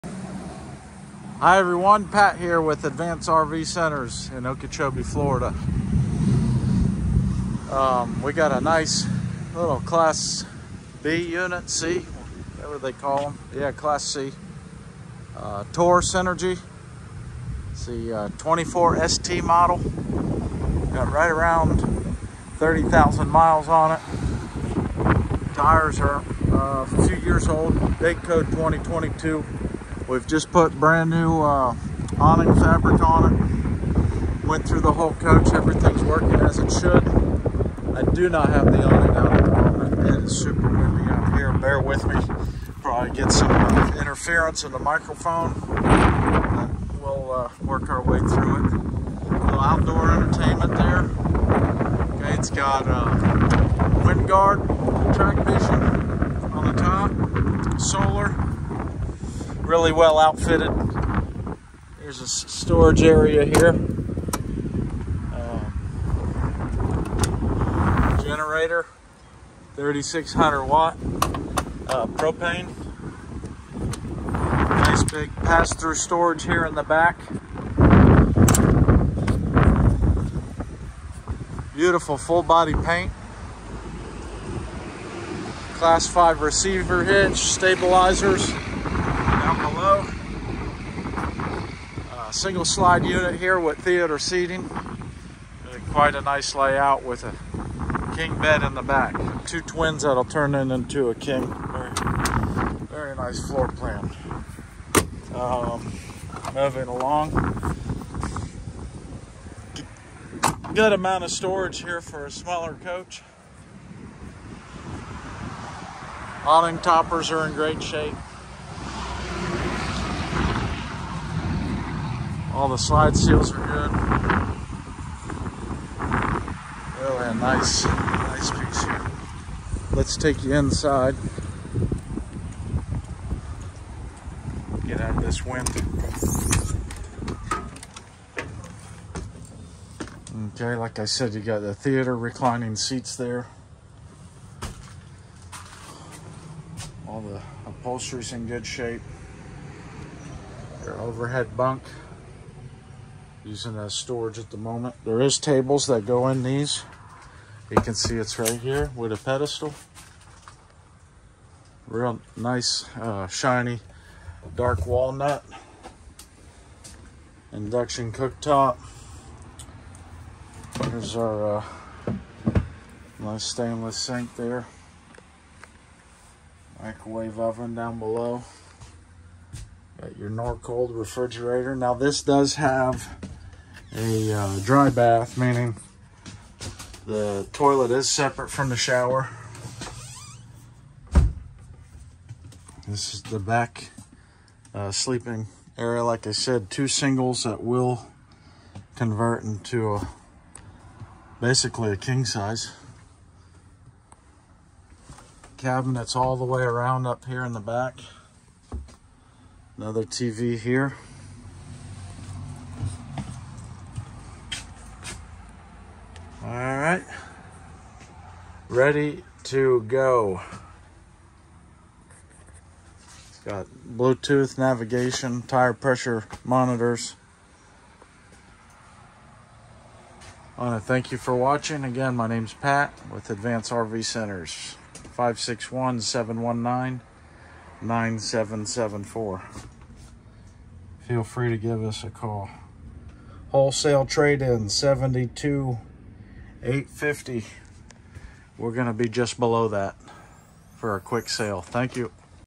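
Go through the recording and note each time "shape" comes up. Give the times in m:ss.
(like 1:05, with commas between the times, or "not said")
1:57, 2:28.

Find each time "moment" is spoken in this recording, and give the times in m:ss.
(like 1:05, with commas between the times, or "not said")
0:39, 2:34.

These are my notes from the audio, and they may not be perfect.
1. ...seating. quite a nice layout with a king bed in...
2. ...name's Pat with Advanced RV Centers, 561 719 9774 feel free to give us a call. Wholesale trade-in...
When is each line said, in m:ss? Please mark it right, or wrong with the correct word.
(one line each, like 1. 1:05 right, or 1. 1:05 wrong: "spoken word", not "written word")
1. 1:34 right
2. 3:52 right.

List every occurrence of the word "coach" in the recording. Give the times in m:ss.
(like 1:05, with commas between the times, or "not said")
0:35, 1:52.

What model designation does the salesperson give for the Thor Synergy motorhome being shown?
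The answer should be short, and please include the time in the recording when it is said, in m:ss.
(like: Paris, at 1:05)
24 ST, at 0:18.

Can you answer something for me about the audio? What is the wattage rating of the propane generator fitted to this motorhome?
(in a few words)
3600 watts.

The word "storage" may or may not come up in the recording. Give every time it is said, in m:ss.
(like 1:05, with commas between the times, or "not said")
1:02, 1:15, 1:51, 2:33.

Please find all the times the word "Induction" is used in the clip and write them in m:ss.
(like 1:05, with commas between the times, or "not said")
2:47.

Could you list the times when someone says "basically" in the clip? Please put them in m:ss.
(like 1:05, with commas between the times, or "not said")
3:21.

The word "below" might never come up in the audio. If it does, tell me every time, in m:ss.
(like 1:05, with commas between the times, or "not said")
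2:57, 4:09.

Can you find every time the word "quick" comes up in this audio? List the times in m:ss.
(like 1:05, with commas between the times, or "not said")
4:11.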